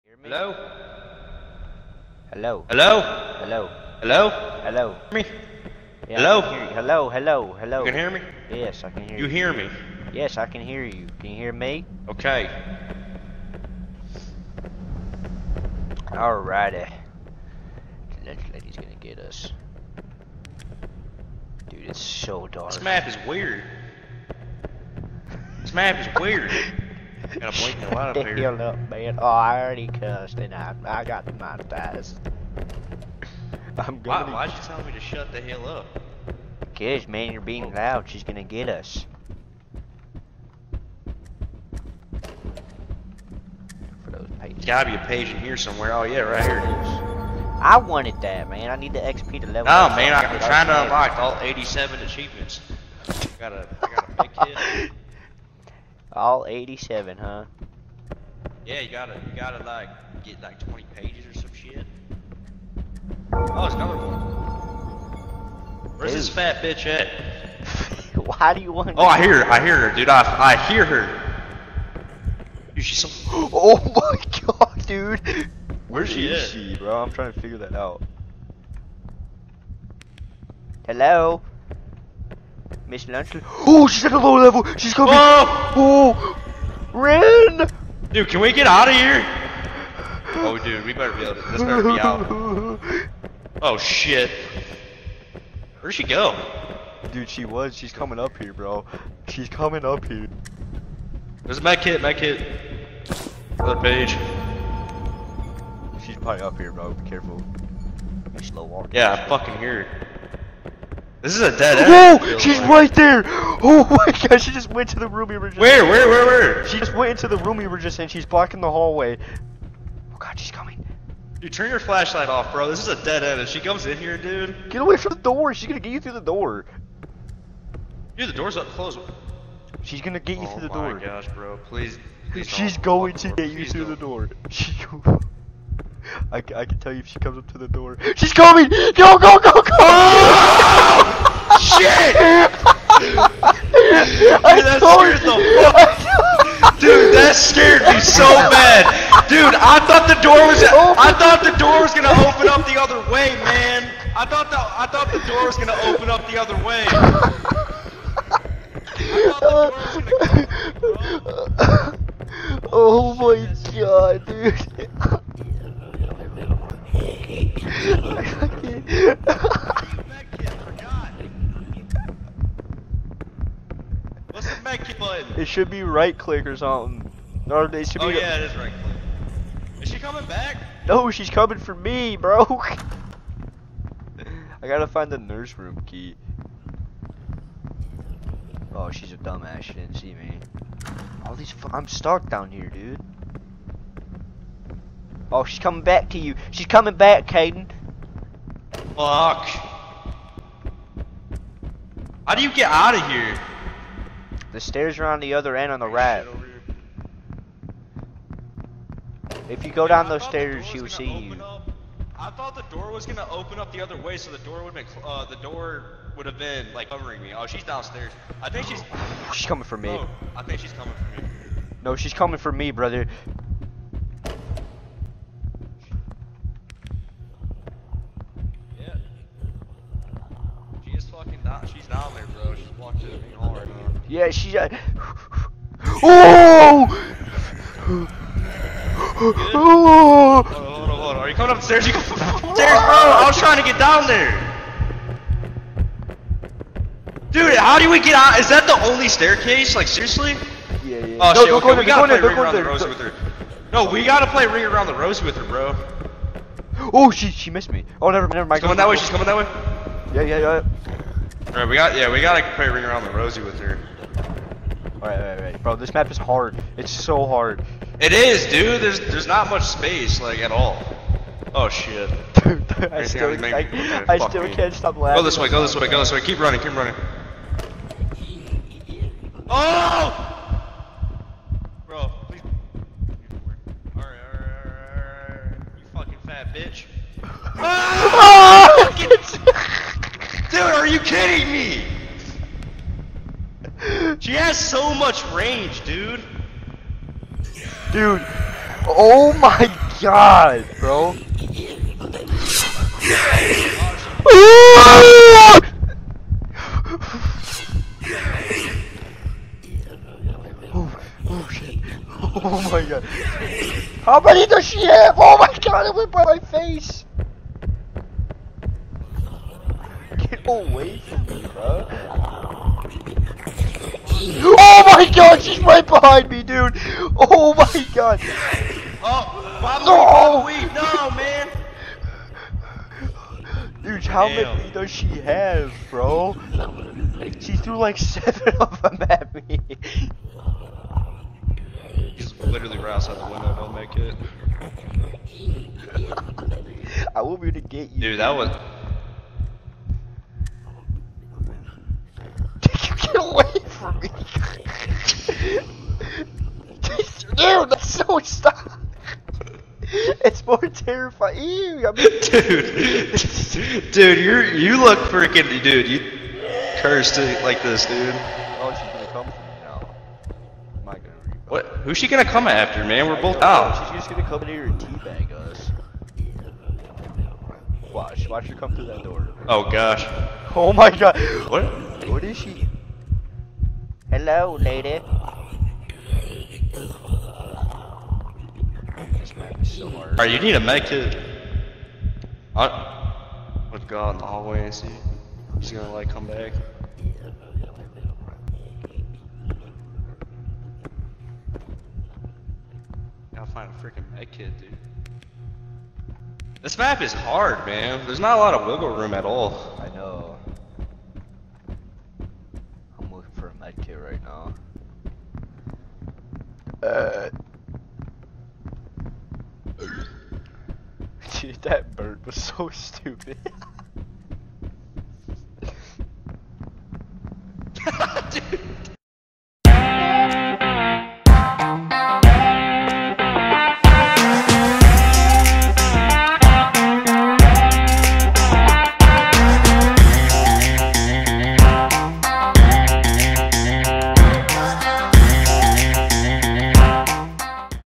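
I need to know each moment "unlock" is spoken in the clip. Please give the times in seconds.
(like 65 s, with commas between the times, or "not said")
50 s.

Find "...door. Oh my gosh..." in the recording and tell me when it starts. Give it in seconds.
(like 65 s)
130 s.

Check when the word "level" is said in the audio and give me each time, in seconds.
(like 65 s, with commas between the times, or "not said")
49 s, 84 s.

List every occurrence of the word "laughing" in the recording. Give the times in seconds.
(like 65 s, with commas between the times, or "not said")
274 s.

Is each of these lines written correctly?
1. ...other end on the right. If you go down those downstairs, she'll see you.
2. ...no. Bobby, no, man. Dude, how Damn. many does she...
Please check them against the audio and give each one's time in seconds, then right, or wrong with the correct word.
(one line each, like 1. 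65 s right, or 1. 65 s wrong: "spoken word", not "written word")
1. 205 s wrong: "stairs", not "downstairs"
2. 329 s right.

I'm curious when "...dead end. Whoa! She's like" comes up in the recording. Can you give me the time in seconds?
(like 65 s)
111 s.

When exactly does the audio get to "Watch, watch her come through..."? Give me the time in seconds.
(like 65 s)
377 s.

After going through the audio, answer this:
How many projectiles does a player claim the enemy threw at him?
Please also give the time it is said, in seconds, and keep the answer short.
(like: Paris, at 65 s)
7, at 337 s.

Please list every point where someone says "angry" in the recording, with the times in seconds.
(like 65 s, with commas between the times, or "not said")
not said.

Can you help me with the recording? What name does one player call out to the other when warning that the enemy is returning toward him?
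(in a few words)
Caden.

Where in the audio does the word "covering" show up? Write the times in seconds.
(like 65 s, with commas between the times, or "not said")
216 s.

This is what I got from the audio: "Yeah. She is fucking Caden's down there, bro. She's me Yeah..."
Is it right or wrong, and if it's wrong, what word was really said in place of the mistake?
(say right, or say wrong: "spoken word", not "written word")
wrong: "She", not "Caden".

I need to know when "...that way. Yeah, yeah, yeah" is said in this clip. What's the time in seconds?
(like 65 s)
259 s.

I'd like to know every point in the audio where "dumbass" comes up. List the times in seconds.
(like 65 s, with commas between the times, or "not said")
189 s.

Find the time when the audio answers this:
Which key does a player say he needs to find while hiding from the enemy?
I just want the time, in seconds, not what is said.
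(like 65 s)
185 s.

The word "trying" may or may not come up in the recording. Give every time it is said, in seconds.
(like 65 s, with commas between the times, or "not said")
50 s, 77 s, 243 s.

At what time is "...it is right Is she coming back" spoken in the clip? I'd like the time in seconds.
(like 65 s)
178 s.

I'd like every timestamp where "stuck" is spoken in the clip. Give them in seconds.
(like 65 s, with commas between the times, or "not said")
191 s, 358 s.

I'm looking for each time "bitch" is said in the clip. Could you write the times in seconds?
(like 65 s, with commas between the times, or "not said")
66 s, 286 s.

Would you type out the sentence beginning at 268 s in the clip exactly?
There's there's not much space, like at all.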